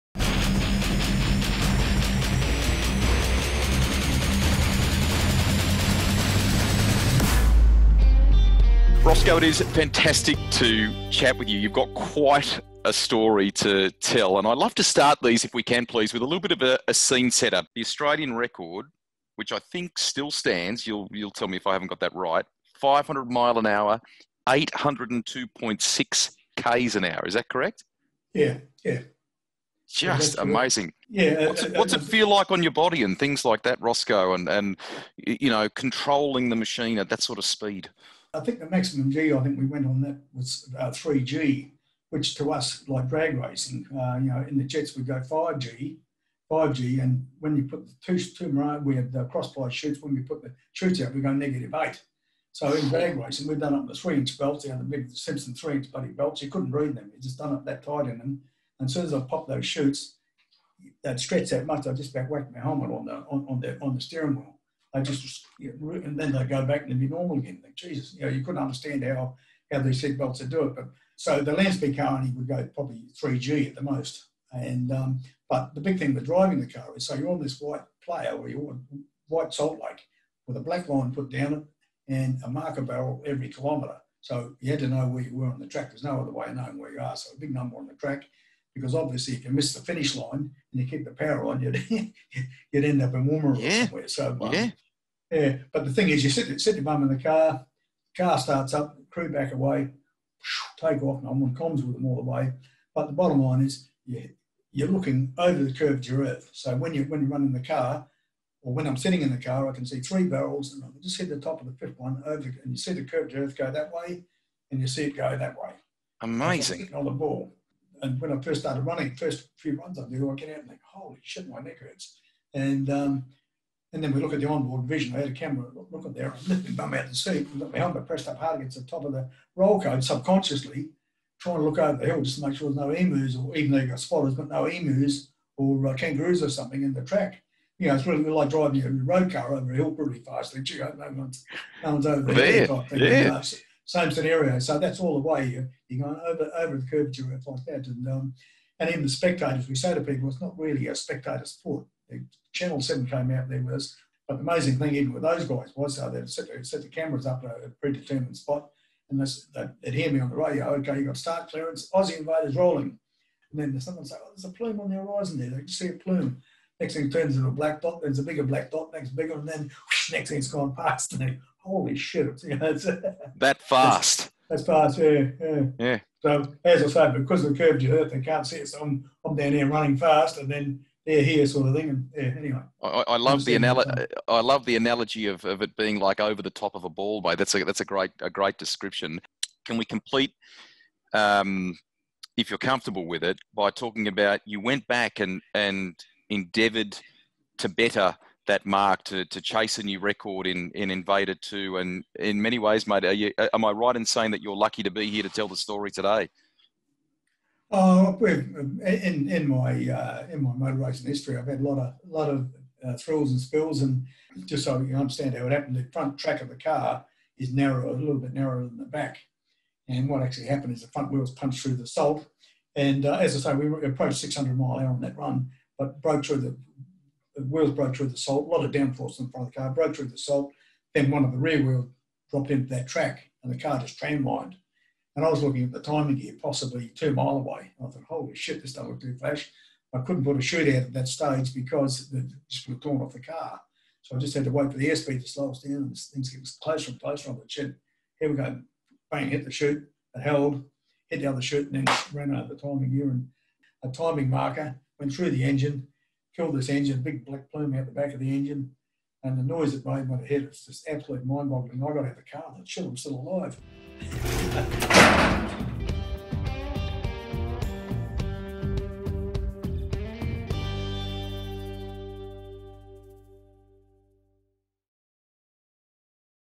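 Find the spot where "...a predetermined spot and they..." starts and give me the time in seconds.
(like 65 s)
157 s.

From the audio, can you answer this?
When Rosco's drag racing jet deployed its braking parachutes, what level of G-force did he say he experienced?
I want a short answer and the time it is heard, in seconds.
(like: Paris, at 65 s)
negative 8, at 51 s.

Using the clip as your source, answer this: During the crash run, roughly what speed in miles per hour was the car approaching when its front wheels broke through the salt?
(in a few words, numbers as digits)
600 mile an hour.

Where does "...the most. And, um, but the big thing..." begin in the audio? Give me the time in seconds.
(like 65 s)
73 s.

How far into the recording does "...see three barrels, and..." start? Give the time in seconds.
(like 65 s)
109 s.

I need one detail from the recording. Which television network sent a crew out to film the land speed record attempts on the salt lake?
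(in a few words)
Channel 7.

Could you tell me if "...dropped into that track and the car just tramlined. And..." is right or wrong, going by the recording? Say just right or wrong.
right.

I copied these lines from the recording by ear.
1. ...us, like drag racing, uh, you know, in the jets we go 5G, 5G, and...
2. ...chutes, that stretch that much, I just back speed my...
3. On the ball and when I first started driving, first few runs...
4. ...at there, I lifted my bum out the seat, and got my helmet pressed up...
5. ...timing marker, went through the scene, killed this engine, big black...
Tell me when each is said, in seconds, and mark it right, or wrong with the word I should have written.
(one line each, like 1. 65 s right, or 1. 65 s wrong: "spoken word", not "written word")
1. 42 s right
2. 59 s wrong: "whacked", not "speed"
3. 116 s wrong: "running", not "driving"
4. 126 s right
5. 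253 s wrong: "engine", not "scene".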